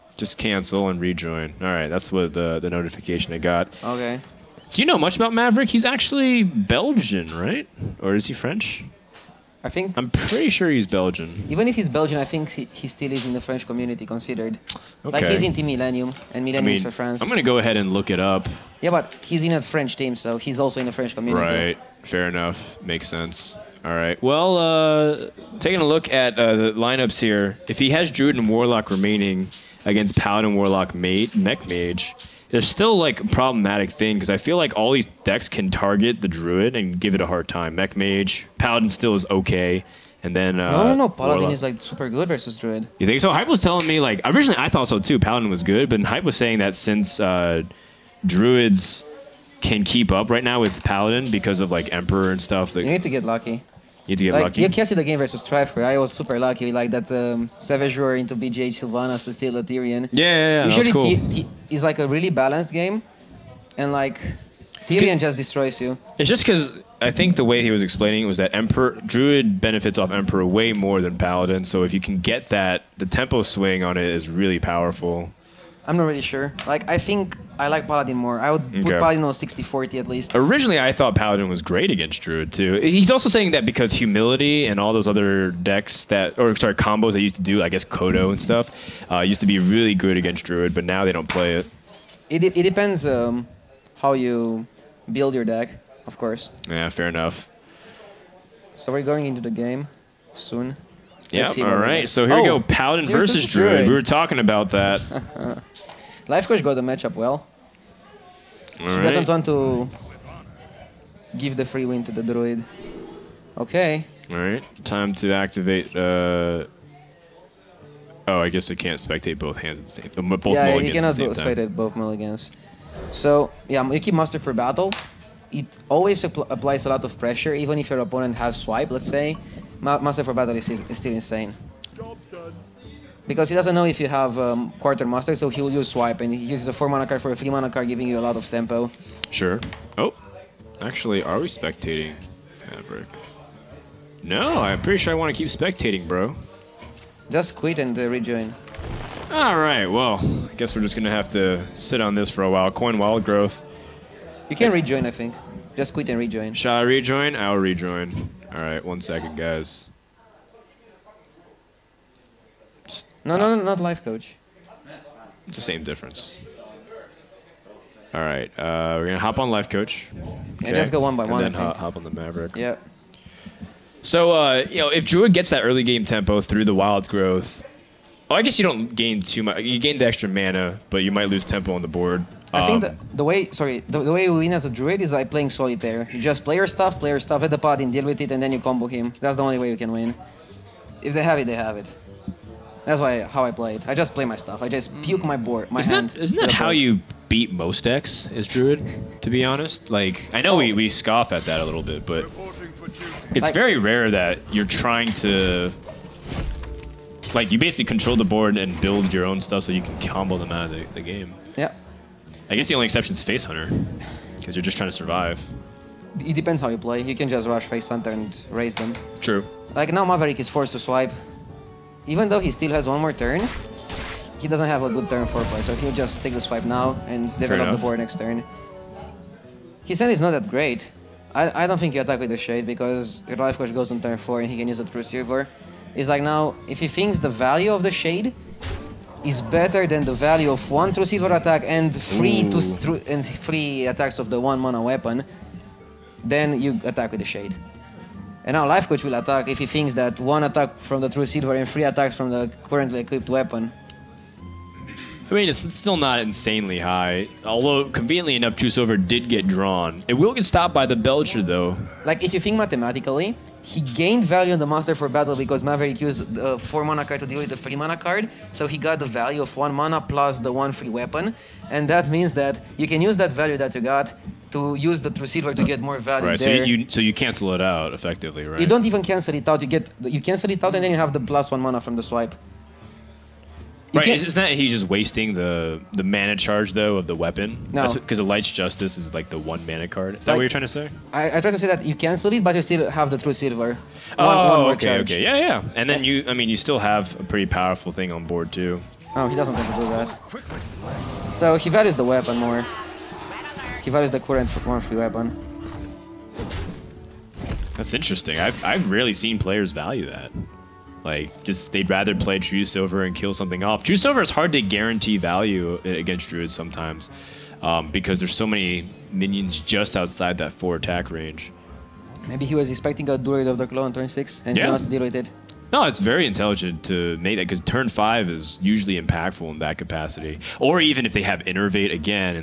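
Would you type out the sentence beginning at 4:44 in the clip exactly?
Isn't that he's just wasting the the mana charge though of the weapon?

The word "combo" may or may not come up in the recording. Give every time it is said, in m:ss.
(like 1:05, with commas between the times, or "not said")
1:26, 3:08, 3:30.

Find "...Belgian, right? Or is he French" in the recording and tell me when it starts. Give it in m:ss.
0:06.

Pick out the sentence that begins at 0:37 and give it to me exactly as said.
Mech mage, paladin still is okay.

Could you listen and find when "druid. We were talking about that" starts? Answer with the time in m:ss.
1:43.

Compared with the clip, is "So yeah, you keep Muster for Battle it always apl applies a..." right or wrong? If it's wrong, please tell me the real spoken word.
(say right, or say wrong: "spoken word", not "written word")
right.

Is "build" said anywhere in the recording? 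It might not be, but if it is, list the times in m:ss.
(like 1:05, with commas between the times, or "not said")
1:35, 3:28.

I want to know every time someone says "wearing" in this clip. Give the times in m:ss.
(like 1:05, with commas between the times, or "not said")
not said.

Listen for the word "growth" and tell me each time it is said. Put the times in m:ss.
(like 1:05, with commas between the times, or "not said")
2:33, 2:57.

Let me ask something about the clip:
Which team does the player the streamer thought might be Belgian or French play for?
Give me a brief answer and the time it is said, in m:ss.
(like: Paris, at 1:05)
Team Millennium, at 0:15.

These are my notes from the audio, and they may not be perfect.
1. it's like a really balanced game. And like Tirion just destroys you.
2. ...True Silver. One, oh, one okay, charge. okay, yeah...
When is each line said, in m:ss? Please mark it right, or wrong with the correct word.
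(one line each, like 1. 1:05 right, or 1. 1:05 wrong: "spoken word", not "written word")
1. 1:01 right
2. 4:53 right.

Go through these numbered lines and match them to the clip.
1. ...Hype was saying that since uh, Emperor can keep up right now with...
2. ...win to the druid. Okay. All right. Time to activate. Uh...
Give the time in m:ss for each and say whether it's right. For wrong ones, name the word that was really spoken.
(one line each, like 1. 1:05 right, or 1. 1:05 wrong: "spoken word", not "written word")
1. 0:46 wrong: "Druids", not "Emperor"
2. 1:51 right.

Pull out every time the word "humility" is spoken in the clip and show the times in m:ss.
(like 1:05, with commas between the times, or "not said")
1:23.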